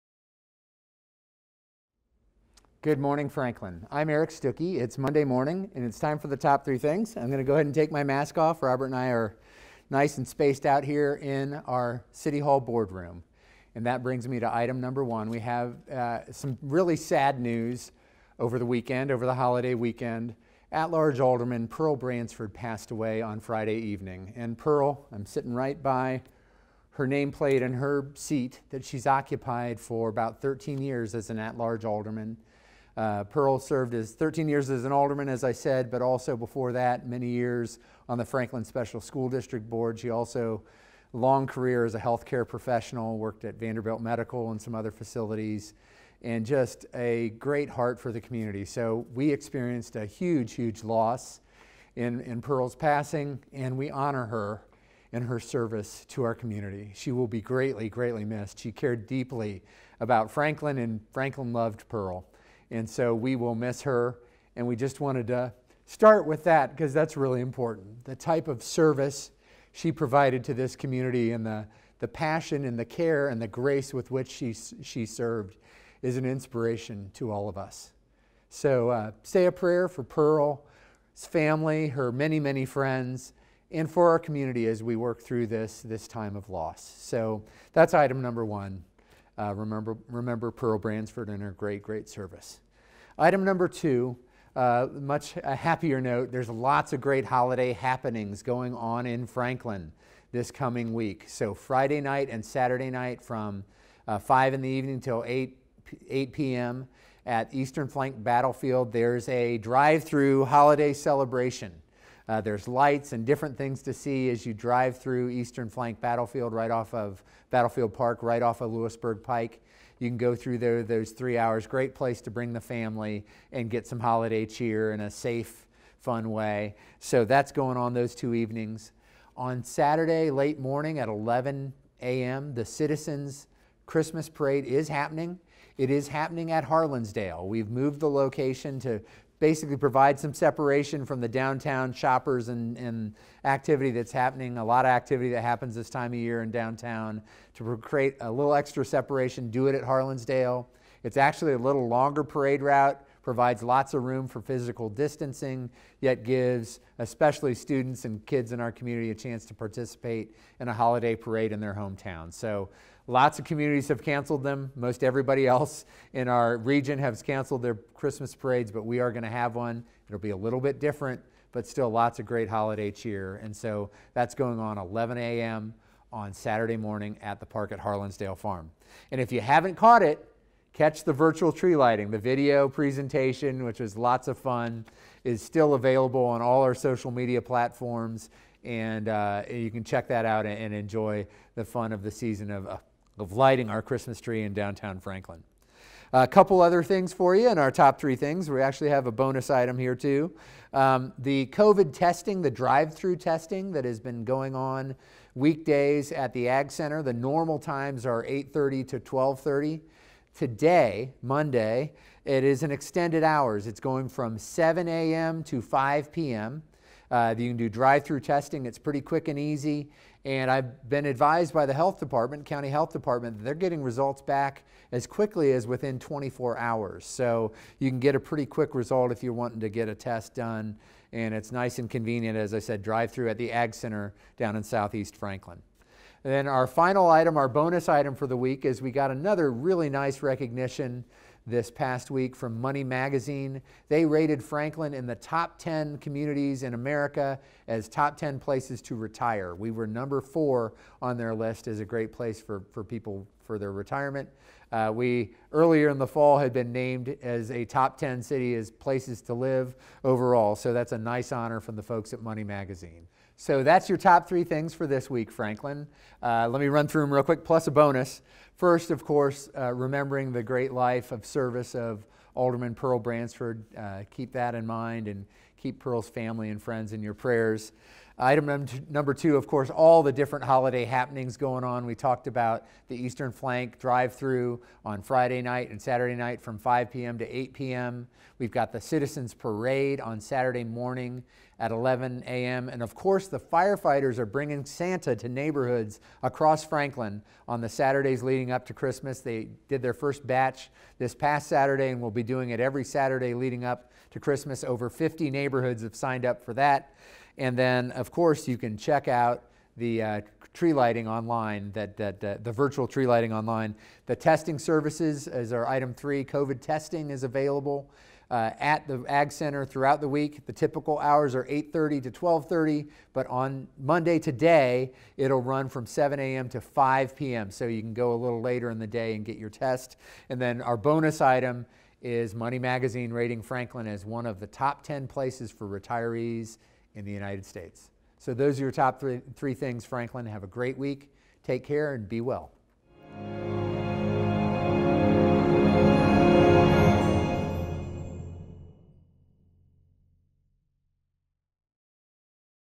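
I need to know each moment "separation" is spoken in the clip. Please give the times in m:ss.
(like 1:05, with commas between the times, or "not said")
2:20, 2:28.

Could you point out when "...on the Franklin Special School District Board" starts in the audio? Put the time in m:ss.
0:38.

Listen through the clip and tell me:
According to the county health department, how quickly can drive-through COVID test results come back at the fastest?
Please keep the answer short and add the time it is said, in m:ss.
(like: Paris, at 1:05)
24 hours, at 3:45.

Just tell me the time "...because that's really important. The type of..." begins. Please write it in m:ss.
1:06.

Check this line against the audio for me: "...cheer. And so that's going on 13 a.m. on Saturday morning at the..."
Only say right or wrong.
wrong.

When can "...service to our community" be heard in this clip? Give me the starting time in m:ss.
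0:55.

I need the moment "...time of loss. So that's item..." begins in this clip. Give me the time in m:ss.
1:26.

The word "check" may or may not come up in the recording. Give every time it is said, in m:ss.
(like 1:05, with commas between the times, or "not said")
3:09, 5:08.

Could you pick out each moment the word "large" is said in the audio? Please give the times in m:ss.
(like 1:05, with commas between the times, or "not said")
0:20, 0:31.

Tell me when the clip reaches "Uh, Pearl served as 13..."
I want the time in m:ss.
0:32.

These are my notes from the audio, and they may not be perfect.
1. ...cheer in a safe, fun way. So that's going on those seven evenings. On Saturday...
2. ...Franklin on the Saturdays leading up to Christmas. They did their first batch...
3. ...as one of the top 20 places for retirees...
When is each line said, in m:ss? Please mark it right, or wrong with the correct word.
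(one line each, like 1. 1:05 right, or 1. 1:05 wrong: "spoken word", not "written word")
1. 2:04 wrong: "two", not "seven"
2. 4:56 right
3. 5:33 wrong: "10", not "20".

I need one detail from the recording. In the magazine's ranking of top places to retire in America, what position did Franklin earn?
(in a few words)
4.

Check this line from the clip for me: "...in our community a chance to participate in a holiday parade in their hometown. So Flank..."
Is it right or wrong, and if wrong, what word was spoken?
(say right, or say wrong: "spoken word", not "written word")
wrong: "Lots", not "Flank".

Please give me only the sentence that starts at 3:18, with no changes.
We actually have a bonus item here, too.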